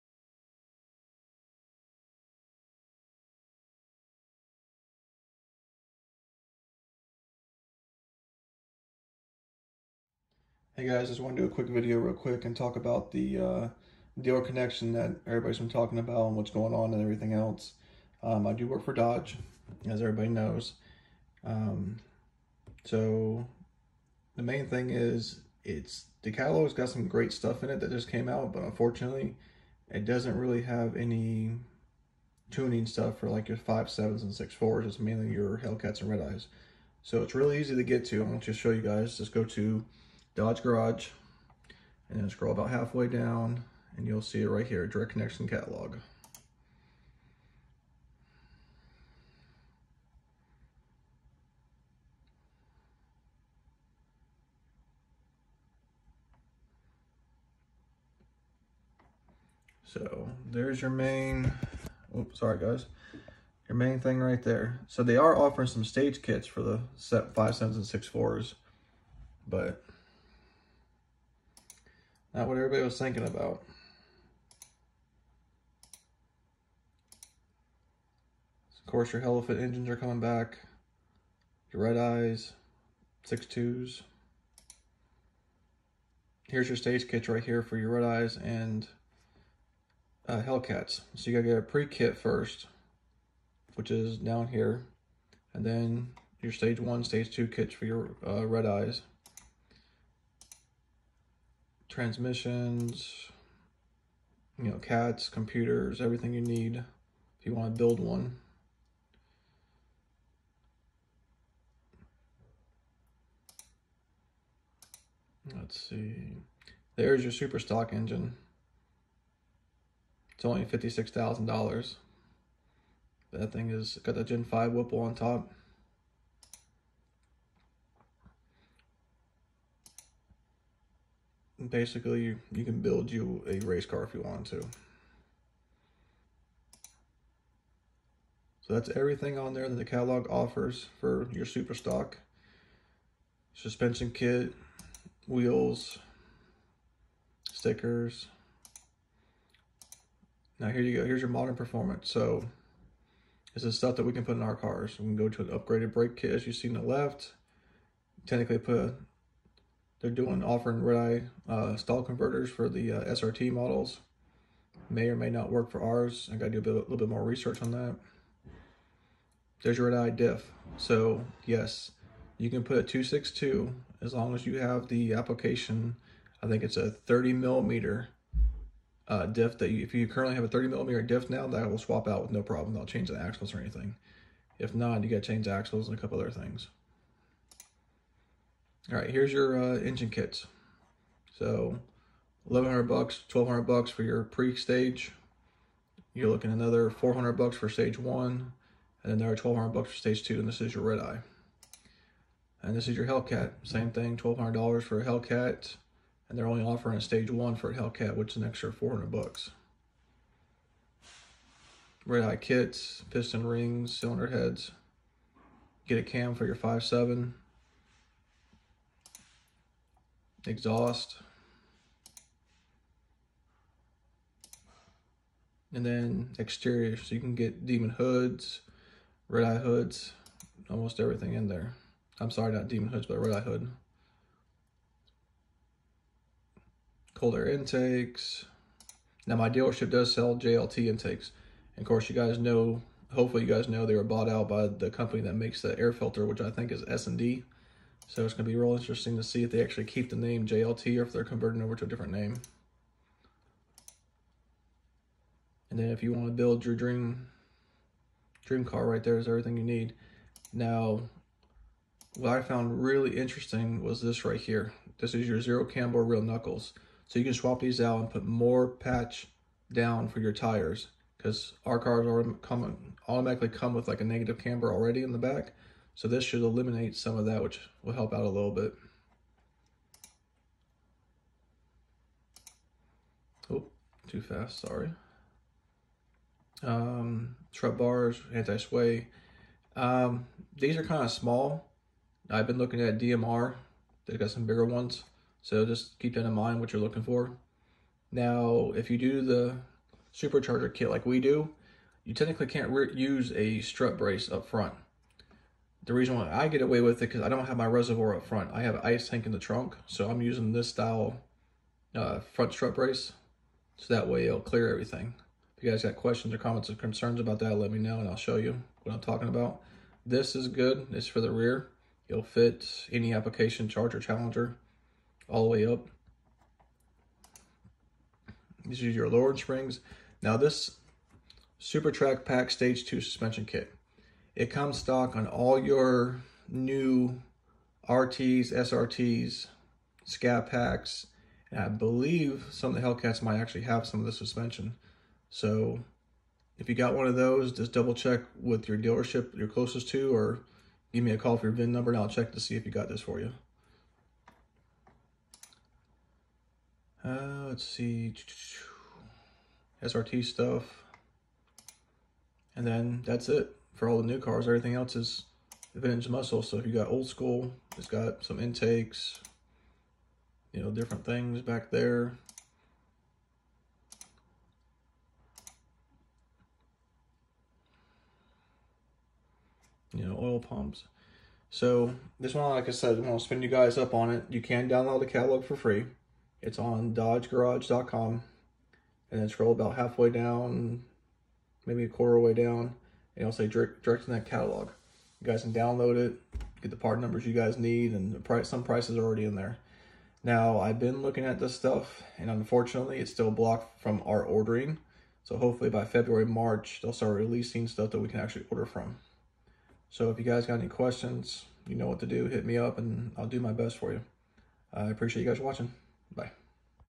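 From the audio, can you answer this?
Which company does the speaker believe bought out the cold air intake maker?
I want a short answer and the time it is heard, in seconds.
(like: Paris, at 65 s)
S&B, at 246 s.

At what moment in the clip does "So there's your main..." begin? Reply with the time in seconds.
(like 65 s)
59 s.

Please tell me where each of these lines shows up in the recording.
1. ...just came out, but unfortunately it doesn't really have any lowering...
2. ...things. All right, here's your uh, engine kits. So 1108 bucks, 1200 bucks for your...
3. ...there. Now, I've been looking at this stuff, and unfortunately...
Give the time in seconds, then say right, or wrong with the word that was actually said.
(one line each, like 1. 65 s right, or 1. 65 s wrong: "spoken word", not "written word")
1. 27 s wrong: "tuning", not "lowering"
2. 186 s wrong: "1100", not "1108"
3. 399 s right.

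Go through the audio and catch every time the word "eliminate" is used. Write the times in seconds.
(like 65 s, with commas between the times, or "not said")
276 s.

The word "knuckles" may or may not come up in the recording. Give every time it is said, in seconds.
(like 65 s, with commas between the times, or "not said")
266 s.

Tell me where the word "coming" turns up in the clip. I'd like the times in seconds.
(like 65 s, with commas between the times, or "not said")
79 s, 272 s.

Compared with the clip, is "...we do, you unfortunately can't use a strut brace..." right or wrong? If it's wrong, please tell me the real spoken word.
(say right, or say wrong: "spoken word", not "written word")
wrong: "technically", not "unfortunately".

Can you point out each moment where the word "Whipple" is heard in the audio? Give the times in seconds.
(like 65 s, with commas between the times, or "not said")
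124 s.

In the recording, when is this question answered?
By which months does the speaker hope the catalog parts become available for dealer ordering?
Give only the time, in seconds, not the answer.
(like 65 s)
405 s.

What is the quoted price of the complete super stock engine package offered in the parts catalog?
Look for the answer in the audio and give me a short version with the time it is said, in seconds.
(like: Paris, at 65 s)
$56,000, at 120 s.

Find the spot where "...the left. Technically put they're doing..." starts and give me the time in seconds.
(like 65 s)
156 s.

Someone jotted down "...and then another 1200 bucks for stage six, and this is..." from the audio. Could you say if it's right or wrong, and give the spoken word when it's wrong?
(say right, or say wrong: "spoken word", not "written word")
wrong: "two", not "six".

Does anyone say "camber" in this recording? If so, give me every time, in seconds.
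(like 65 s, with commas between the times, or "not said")
265 s, 274 s.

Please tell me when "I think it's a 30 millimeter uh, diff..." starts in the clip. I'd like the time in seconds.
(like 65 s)
176 s.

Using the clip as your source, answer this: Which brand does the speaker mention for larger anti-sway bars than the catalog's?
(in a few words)
BMR.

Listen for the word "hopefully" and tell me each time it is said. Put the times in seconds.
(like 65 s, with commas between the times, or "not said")
243 s, 405 s.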